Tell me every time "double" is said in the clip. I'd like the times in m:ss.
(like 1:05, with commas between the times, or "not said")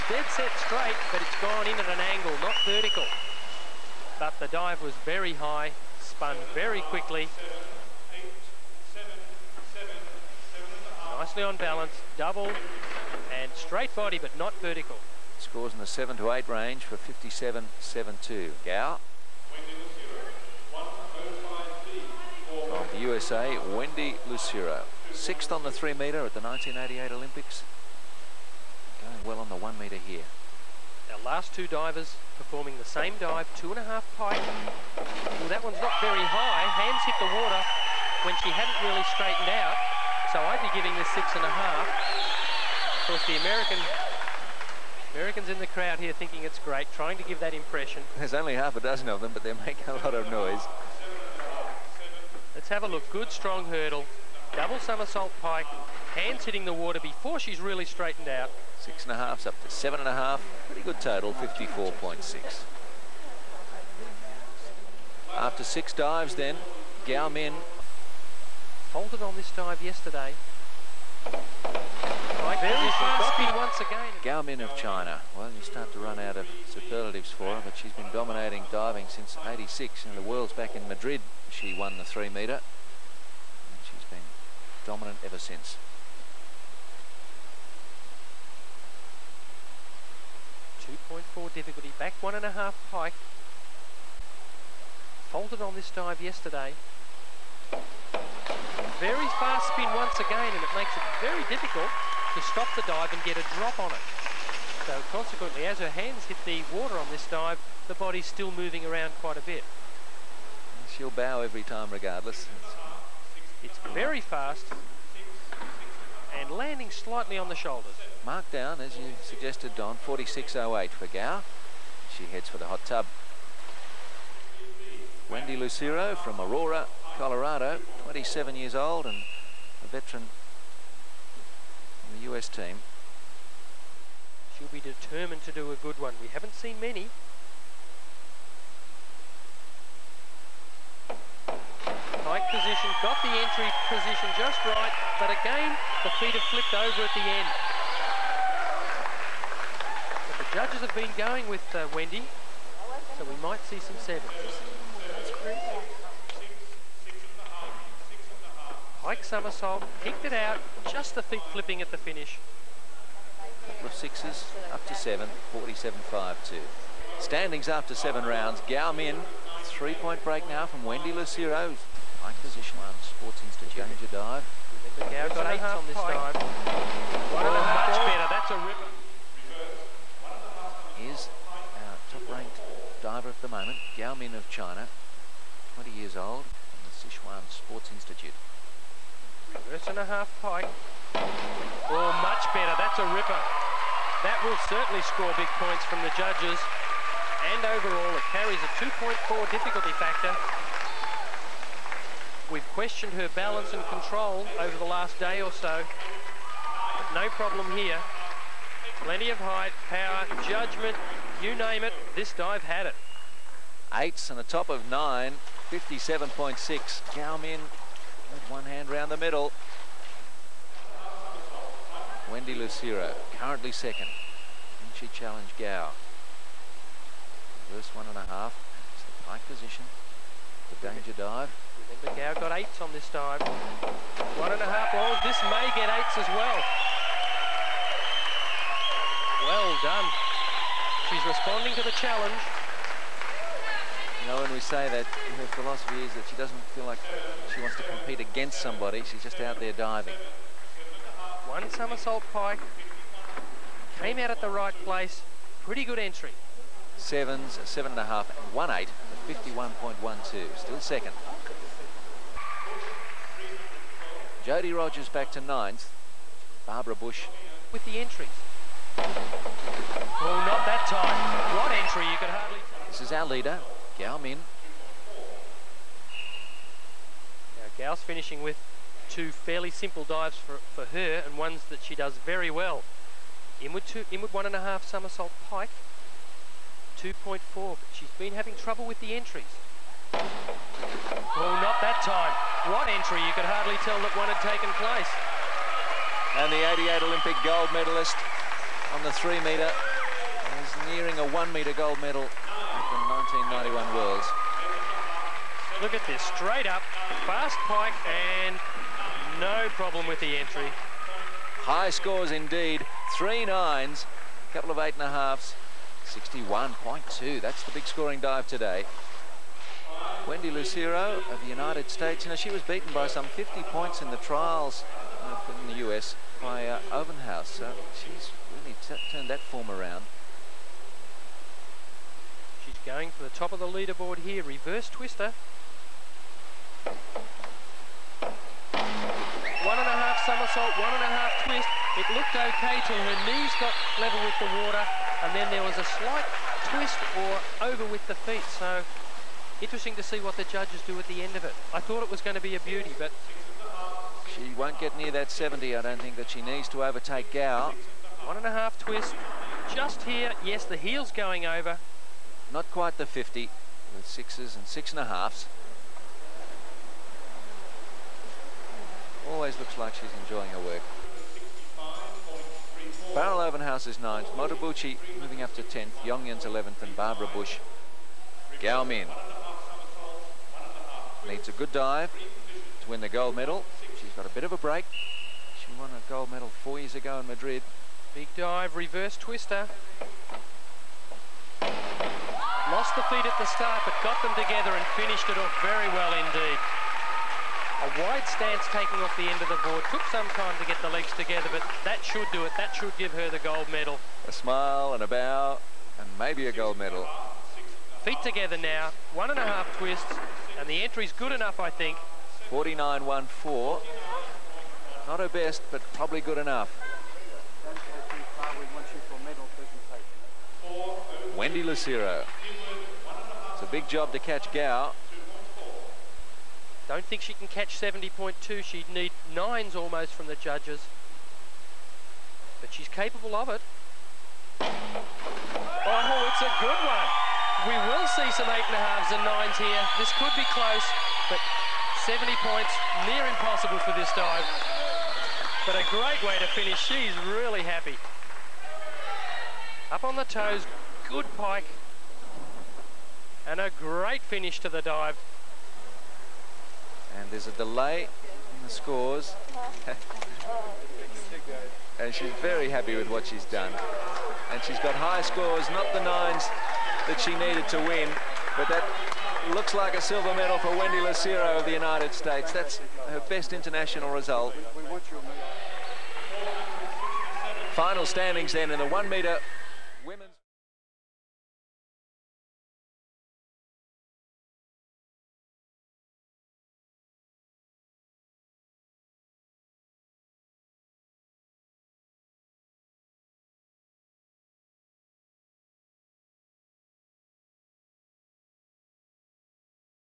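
0:12, 0:54.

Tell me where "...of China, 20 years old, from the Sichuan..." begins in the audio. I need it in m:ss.
3:04.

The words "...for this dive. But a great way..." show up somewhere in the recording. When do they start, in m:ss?
7:23.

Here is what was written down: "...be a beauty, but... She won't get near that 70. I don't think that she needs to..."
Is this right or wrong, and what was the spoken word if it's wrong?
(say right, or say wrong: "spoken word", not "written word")
right.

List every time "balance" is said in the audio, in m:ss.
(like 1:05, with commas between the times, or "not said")
0:11, 3:23.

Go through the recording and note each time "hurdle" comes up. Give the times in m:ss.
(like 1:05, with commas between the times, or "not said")
0:53.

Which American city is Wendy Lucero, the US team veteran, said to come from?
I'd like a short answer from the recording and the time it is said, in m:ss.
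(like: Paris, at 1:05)
Aurora, Colorado, at 2:06.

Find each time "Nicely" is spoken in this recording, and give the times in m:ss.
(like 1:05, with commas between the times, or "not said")
0:11.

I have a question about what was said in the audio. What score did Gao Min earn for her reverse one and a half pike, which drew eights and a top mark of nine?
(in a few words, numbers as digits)
57.6.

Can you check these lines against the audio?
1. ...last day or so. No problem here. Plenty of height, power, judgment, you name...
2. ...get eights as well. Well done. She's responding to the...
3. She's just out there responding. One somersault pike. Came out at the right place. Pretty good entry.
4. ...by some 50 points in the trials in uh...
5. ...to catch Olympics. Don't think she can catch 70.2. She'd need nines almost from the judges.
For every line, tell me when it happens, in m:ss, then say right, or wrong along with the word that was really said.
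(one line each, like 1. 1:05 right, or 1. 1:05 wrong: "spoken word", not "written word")
1. 3:24 right
2. 3:55 right
3. 4:09 wrong: "diving", not "responding"
4. 5:22 right
5. 7:04 wrong: "Gao", not "Olympics".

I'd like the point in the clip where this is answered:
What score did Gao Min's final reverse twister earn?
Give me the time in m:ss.
6:52.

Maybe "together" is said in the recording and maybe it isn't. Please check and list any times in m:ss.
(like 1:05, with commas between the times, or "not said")
6:34, 6:41, 6:48.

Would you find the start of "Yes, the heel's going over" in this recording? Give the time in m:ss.
6:00.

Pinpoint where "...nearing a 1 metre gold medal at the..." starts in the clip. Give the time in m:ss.
5:00.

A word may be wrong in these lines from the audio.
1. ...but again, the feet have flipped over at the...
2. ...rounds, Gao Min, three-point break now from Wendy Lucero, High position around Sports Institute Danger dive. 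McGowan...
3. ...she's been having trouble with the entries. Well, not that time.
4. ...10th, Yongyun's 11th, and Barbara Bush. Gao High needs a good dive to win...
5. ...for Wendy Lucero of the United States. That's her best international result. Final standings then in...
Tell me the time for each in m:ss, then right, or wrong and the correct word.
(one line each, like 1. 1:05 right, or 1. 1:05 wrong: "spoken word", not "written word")
1. 2:25 right
2. 2:48 right
3. 4:47 right
4. 6:15 wrong: "Min", not "High"
5. 7:50 right.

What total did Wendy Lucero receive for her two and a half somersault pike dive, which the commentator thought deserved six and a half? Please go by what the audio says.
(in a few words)
54.6.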